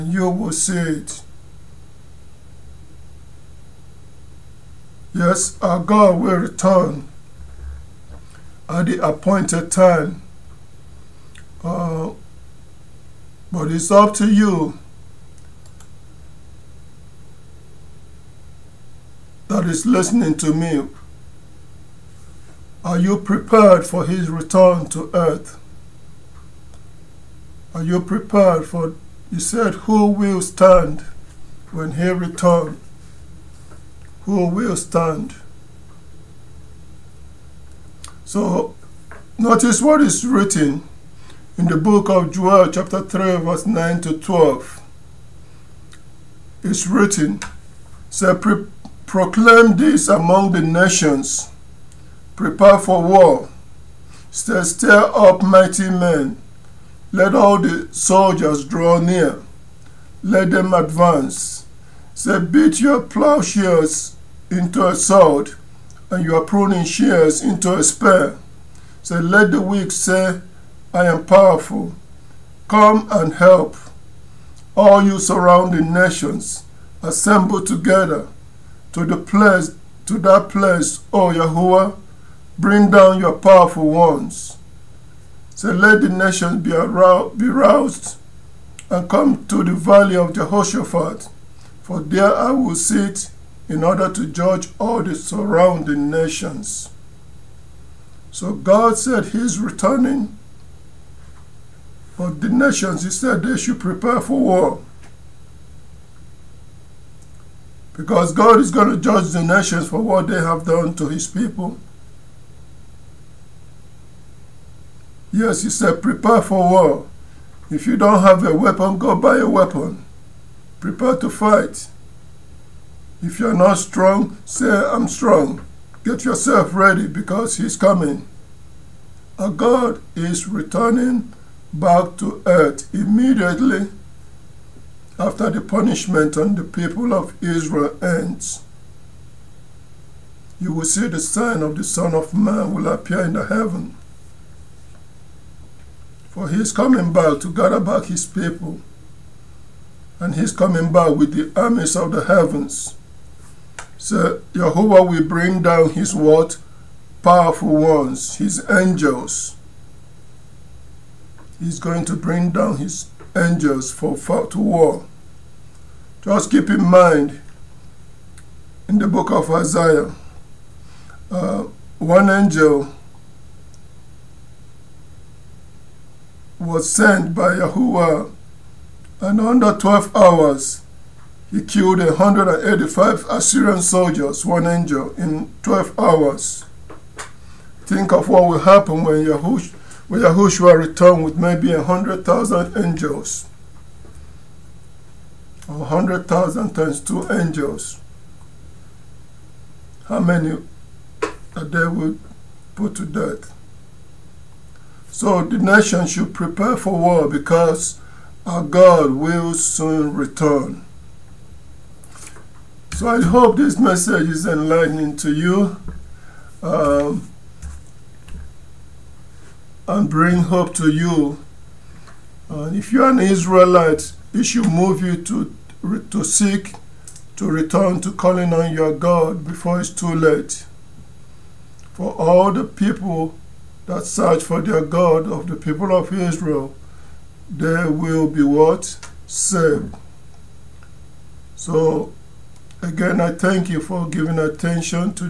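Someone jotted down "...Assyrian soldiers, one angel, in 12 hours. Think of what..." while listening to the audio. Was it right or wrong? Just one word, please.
right.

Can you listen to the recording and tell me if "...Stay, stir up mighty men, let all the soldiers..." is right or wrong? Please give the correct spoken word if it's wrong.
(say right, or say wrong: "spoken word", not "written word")
right.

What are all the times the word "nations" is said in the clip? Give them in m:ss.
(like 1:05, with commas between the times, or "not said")
0:50, 1:15, 1:26, 1:36, 1:42, 1:49, 3:25.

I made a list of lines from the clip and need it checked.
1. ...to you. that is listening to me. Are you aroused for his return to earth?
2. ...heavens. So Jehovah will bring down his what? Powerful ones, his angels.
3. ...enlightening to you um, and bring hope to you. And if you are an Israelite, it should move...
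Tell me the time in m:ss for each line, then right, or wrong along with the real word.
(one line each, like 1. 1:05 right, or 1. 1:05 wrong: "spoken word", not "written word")
1. 0:14 wrong: "prepared", not "aroused"
2. 2:32 right
3. 3:34 right.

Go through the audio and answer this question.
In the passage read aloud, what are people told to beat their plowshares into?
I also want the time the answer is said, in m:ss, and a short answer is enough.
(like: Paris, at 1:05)
A sword, at 1:04.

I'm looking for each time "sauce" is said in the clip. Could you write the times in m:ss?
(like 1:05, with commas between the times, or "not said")
not said.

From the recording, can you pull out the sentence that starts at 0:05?
Yes, our God will return at the appointed time.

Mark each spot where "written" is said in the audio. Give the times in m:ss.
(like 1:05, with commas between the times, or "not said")
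0:40, 0:46.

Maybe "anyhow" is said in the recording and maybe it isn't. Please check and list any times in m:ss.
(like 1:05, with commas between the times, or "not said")
not said.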